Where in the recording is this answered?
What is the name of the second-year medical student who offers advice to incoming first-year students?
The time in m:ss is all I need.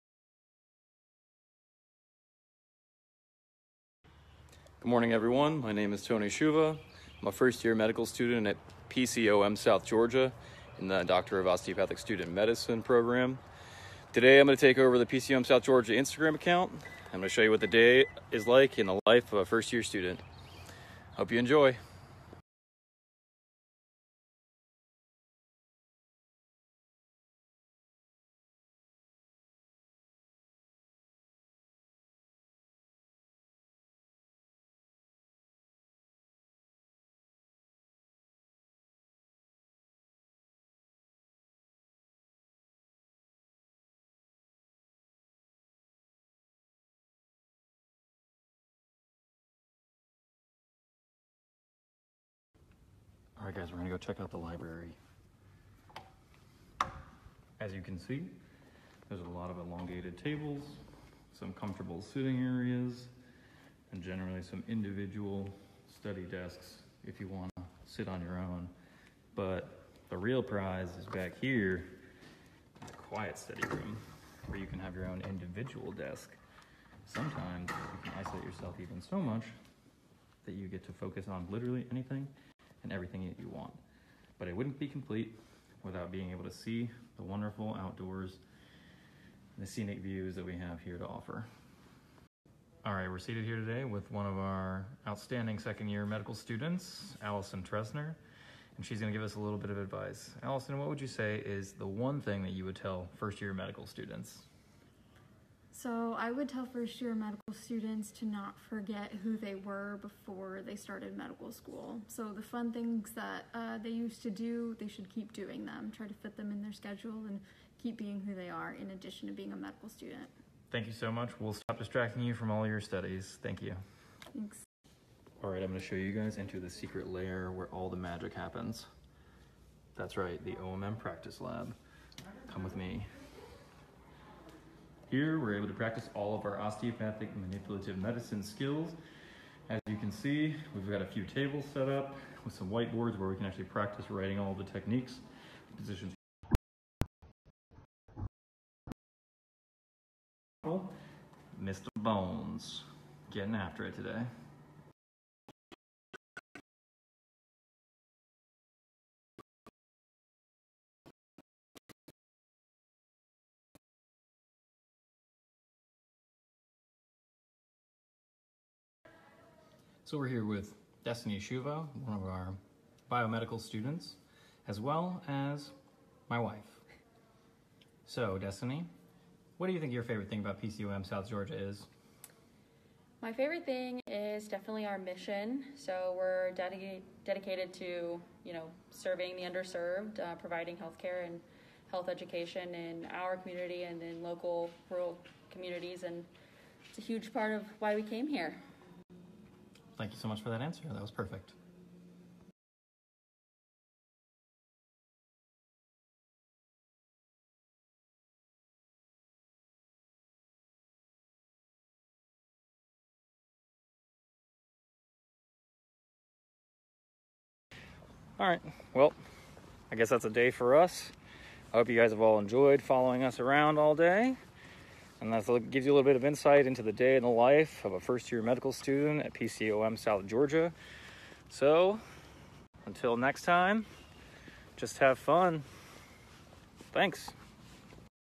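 1:37.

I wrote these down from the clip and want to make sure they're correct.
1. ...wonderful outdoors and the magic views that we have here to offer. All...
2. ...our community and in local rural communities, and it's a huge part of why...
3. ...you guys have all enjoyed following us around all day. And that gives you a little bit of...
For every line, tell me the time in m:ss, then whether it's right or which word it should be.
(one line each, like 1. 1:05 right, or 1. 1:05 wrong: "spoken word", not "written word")
1. 1:27 wrong: "scenic", not "magic"
2. 3:13 right
3. 3:41 right.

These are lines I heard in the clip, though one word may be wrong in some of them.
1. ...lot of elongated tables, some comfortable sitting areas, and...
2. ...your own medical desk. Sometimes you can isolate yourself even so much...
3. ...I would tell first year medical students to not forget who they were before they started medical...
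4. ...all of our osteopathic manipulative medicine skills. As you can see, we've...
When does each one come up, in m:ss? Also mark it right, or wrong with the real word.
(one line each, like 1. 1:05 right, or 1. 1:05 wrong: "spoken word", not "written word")
1. 0:59 right
2. 1:14 wrong: "individual", not "medical"
3. 1:46 right
4. 2:16 right.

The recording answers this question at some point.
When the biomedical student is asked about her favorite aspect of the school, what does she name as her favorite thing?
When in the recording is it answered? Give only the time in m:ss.
3:04.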